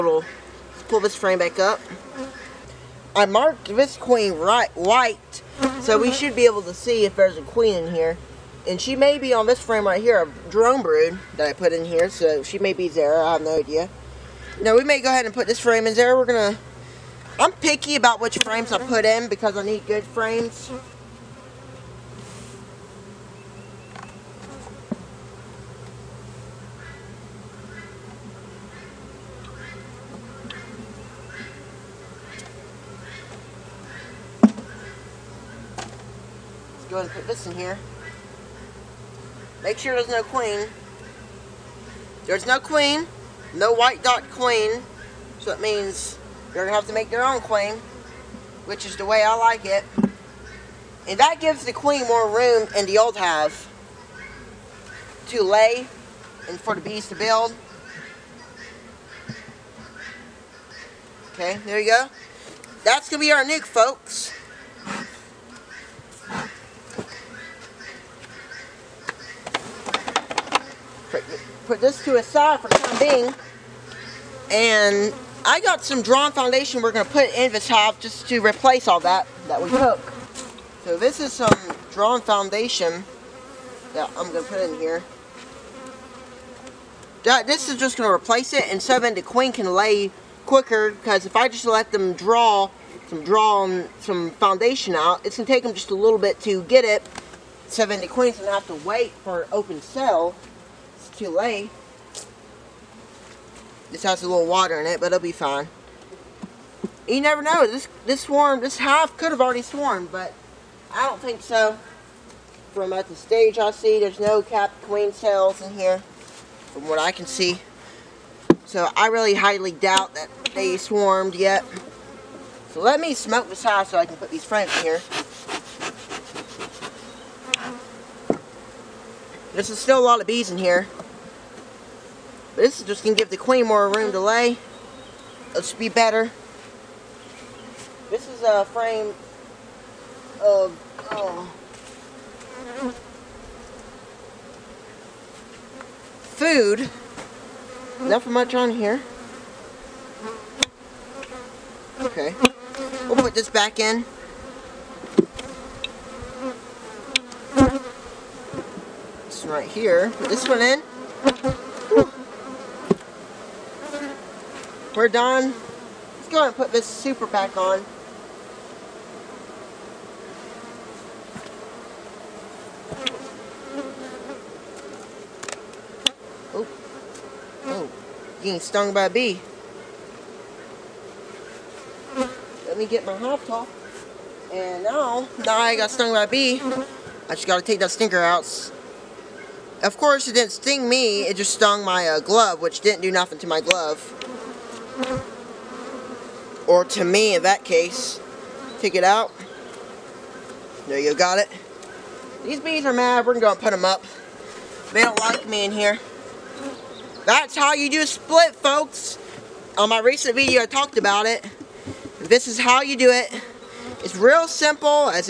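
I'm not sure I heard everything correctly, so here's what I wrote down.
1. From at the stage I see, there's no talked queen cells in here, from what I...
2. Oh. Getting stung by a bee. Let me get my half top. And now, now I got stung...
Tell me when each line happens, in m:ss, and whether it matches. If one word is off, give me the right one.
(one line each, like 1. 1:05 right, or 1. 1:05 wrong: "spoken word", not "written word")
1. 1:52 wrong: "capped", not "talked"
2. 2:57 right.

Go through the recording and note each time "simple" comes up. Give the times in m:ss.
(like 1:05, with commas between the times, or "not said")
3:34.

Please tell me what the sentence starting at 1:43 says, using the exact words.
This has a little water in it, but it'll be fine.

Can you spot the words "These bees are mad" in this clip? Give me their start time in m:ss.
3:22.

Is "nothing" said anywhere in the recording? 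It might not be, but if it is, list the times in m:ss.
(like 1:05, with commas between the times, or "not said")
2:27, 3:13.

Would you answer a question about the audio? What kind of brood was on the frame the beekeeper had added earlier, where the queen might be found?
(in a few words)
Drone brood.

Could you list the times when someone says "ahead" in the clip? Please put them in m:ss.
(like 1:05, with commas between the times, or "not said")
0:15, 0:36, 2:46.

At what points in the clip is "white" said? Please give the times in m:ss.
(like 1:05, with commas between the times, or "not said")
0:04, 0:43.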